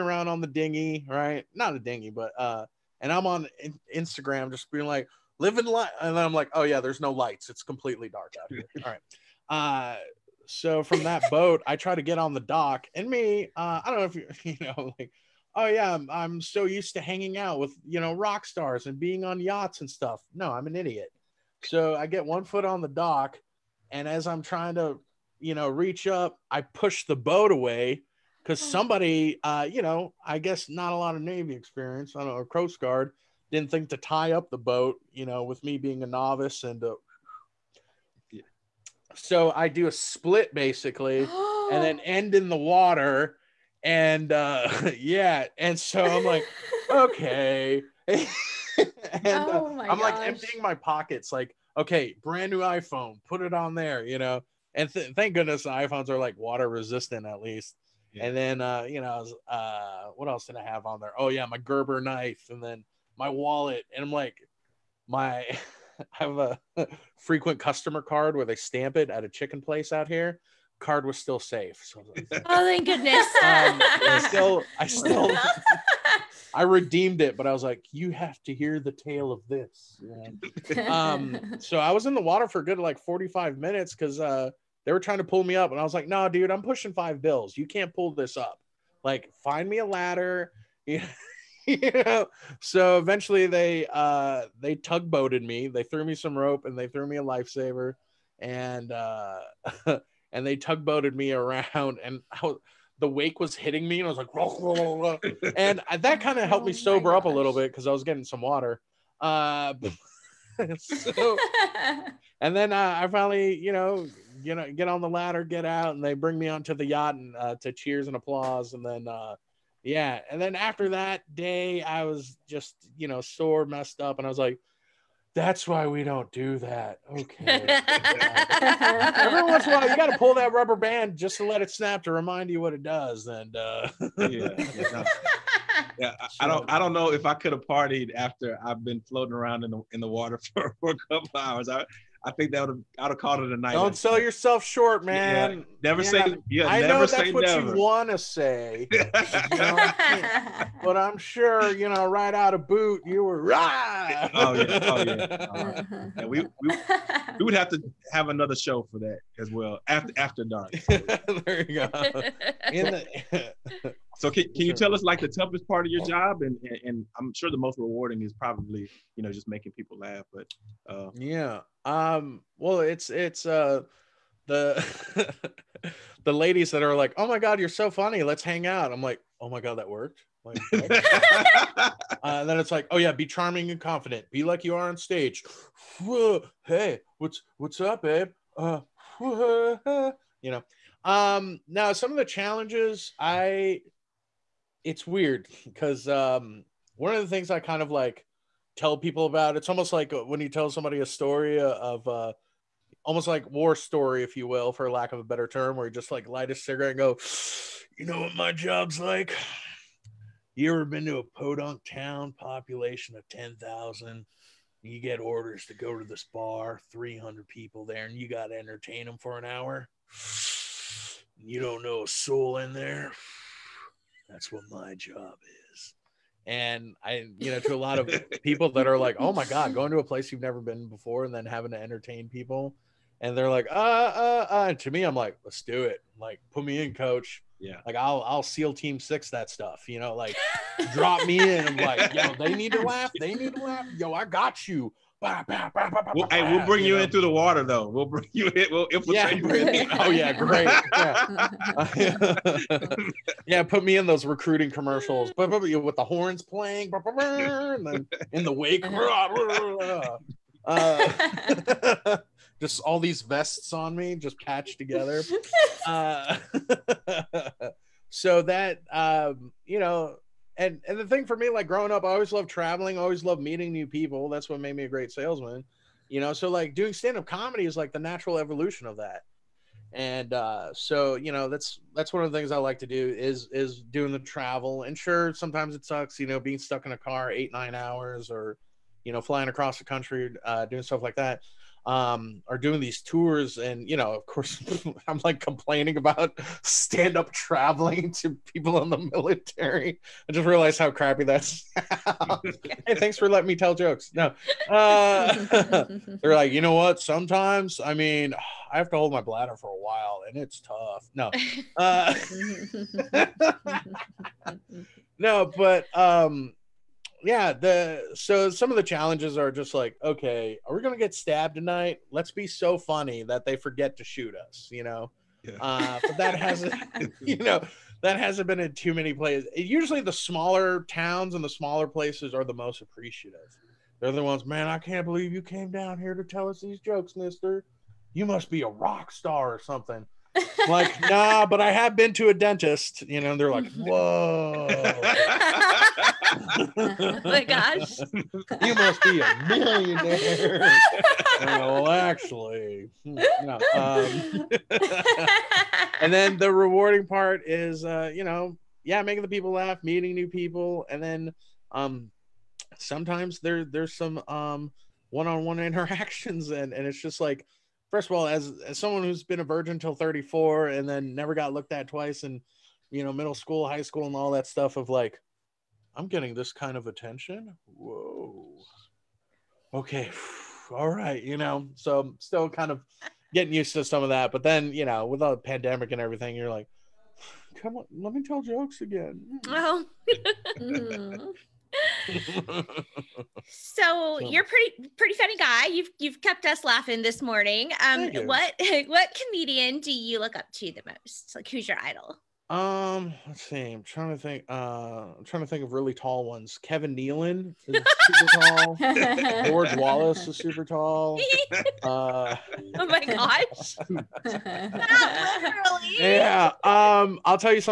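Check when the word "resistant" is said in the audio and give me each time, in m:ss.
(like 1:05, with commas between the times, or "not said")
0:56.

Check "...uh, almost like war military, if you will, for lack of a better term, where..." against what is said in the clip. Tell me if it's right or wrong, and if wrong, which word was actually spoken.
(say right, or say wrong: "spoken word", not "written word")
wrong: "story", not "military".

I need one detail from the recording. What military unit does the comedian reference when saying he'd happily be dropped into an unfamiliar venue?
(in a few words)
SEAL Team Six.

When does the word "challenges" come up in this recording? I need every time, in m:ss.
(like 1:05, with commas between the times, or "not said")
3:12, 5:18.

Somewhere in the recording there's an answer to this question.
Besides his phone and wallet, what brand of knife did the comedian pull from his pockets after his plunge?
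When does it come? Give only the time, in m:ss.
1:01.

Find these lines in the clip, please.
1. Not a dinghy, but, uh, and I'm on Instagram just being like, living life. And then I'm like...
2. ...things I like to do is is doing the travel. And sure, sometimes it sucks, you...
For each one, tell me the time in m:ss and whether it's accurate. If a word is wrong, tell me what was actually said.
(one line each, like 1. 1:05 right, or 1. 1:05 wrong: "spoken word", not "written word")
1. 0:01 right
2. 4:42 right.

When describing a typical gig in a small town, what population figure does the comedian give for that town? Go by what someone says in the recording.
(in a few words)
10,000.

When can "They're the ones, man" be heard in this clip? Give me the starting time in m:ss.
5:33.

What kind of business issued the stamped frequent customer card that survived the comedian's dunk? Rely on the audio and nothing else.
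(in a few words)
chicken place.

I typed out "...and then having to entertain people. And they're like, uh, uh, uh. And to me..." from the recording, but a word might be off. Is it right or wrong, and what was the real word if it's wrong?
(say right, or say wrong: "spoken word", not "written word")
right.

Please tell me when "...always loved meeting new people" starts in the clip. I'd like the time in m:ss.
4:32.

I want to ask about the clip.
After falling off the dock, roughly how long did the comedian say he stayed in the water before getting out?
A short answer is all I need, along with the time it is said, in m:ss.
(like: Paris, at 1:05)
45 minutes, at 1:22.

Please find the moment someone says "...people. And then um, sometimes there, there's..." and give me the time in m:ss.
6:00.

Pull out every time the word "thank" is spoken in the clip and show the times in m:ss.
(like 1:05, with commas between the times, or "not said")
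0:55, 1:12, 5:02.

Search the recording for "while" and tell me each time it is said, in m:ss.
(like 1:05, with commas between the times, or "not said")
2:09, 5:09.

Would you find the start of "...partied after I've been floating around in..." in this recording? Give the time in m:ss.
2:17.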